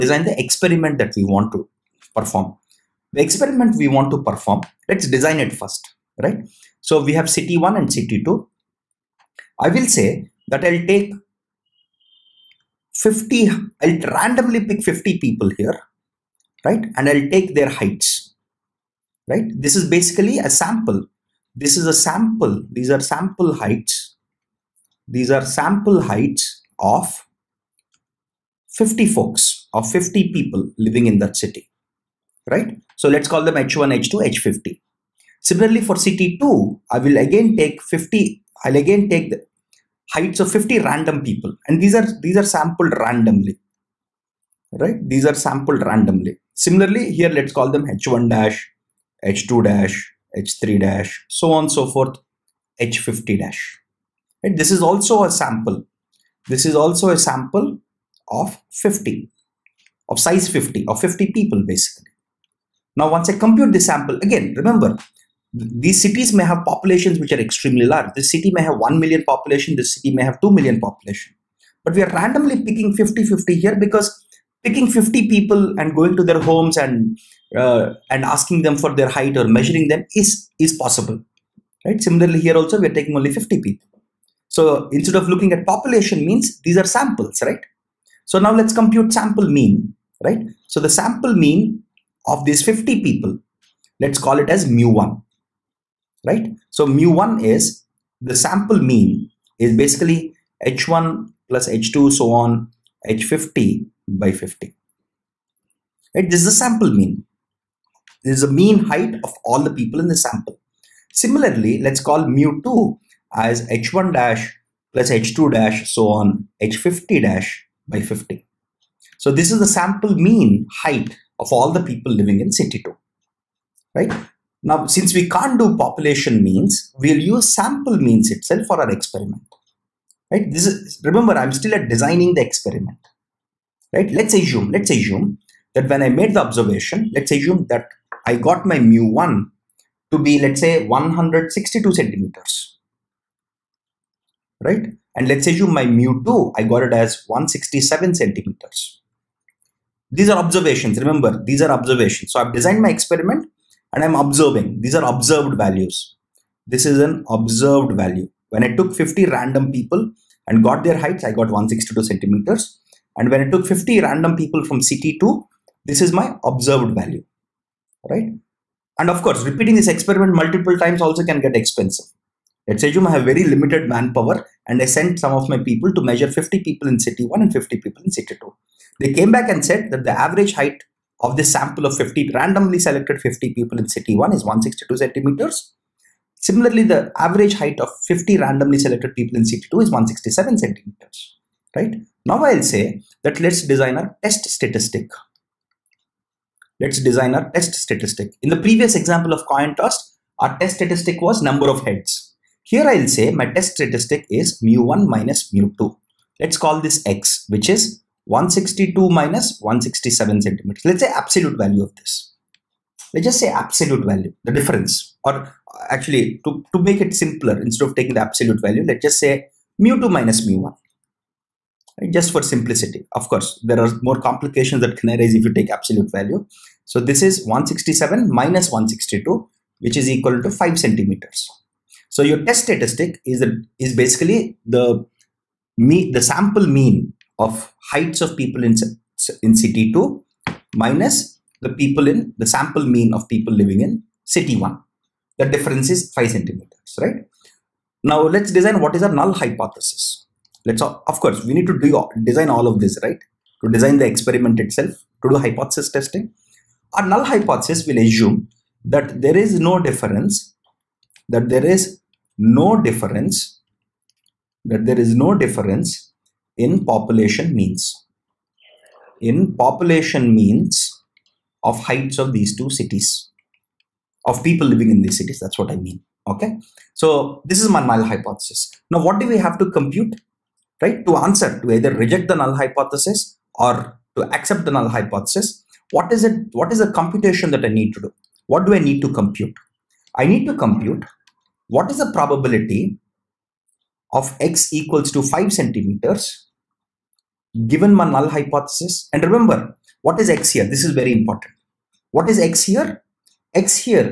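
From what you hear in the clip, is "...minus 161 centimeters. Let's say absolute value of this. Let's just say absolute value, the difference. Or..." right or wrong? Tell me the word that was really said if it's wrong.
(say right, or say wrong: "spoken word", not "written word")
wrong: "167", not "161".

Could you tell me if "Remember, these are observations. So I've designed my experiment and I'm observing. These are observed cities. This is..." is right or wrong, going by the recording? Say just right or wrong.
wrong.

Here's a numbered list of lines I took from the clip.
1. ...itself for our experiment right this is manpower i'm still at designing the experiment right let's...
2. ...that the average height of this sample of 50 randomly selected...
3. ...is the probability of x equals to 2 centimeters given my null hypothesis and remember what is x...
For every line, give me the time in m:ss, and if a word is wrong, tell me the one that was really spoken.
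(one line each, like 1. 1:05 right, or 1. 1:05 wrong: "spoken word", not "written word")
1. 2:08 wrong: "remember", not "manpower"
2. 2:59 right
3. 4:51 wrong: "5", not "2".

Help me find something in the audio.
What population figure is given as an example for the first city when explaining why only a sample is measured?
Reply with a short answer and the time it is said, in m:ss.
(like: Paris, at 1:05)
1 million, at 1:08.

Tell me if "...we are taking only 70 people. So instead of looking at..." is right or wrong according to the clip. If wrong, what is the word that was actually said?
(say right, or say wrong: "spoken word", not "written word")
wrong: "50", not "70".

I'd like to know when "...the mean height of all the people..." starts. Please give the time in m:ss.
1:48.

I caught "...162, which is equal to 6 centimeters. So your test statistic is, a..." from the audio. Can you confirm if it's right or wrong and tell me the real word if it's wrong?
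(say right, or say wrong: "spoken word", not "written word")
wrong: "5", not "6".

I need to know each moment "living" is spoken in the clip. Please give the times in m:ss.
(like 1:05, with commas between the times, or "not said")
0:30, 2:02, 4:03, 4:34.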